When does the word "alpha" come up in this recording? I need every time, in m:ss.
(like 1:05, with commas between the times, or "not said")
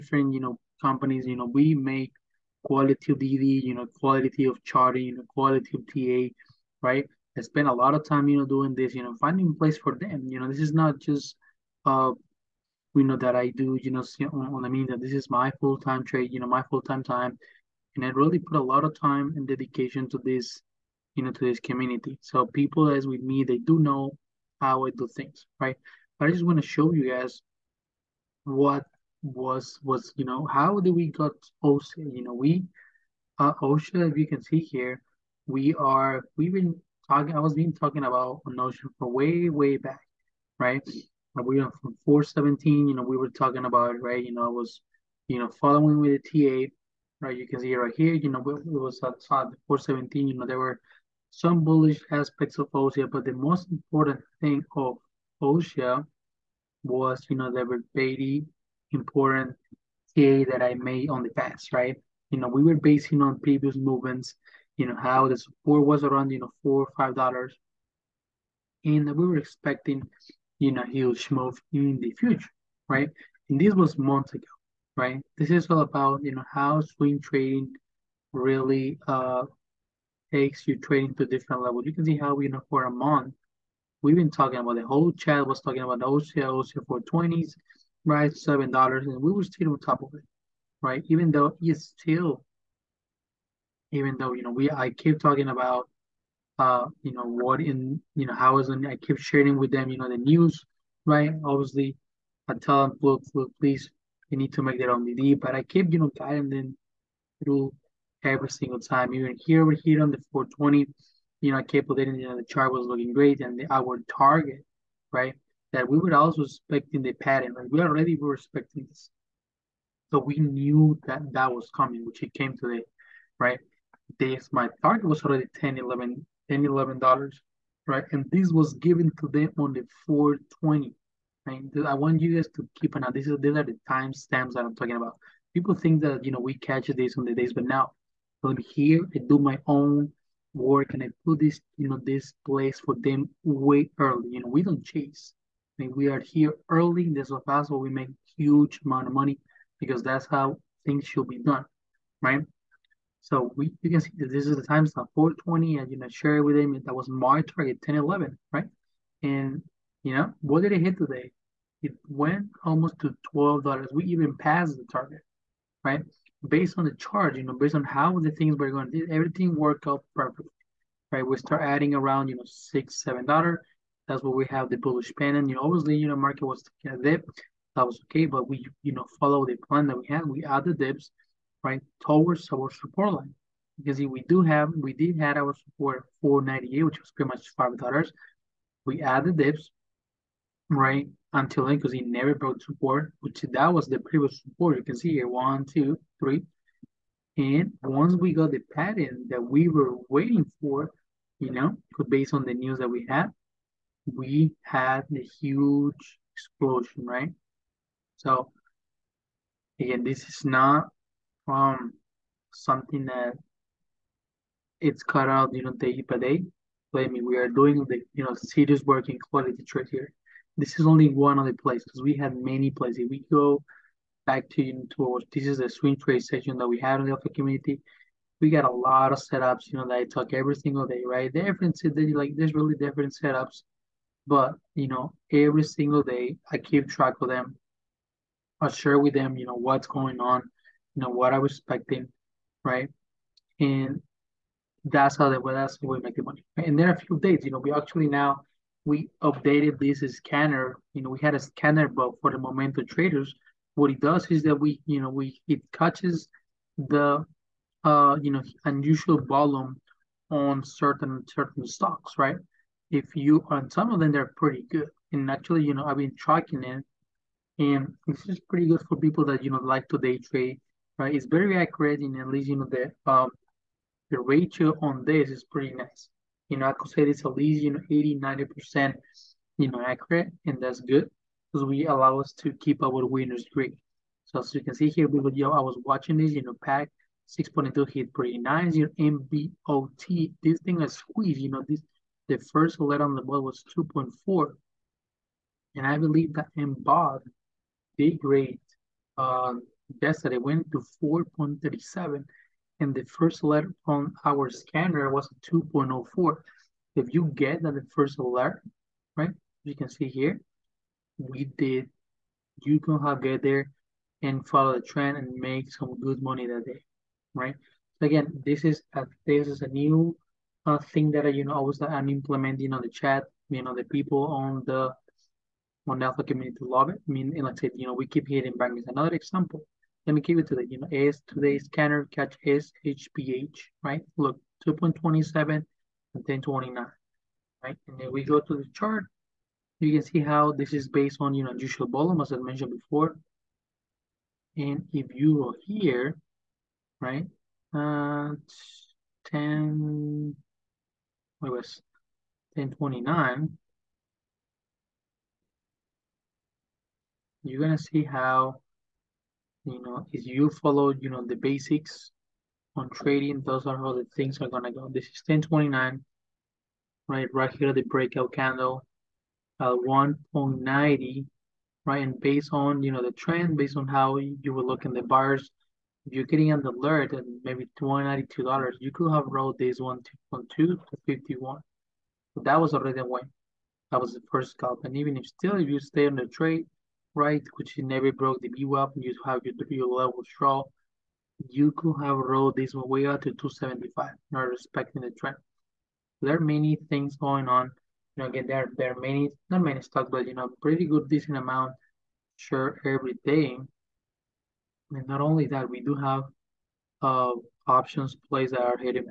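3:47, 5:26.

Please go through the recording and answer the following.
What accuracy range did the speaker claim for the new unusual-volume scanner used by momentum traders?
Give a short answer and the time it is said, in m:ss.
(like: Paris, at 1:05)
80-90%, at 4:37.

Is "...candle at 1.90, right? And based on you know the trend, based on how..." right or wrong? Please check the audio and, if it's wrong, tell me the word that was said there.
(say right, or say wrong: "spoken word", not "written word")
right.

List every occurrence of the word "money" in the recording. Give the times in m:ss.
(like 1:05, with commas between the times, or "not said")
2:29, 4:06, 5:16.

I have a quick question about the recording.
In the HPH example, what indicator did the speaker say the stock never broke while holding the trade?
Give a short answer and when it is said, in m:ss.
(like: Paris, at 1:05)
VWAP, at 6:28.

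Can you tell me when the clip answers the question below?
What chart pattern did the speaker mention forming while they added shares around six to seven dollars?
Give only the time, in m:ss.
2:54.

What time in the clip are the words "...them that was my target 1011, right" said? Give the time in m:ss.
2:36.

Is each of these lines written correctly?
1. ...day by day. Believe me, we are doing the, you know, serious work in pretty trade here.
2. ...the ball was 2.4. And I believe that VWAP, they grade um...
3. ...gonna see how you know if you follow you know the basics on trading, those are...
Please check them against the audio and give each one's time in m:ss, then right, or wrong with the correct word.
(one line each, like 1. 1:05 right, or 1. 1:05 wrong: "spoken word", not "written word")
1. 3:35 wrong: "quality", not "pretty"
2. 4:53 wrong: "MBOT", not "VWAP"
3. 5:57 right.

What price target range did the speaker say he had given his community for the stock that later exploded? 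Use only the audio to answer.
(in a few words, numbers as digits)
$10-11.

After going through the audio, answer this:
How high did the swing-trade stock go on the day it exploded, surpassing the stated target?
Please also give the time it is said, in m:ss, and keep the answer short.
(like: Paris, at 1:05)
almost $12, at 2:42.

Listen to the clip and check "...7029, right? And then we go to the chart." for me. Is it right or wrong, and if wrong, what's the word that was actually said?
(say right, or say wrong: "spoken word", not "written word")
wrong: "1029", not "7029".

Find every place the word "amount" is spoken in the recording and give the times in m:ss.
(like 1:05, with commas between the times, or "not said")
2:28, 6:41.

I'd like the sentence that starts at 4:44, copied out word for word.
So as you can see here, we would, you know, I was watching this, you know, pack 6.2 hit pretty nice.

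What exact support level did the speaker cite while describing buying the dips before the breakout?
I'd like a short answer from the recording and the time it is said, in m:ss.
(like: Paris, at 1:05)
4.98, at 3:06.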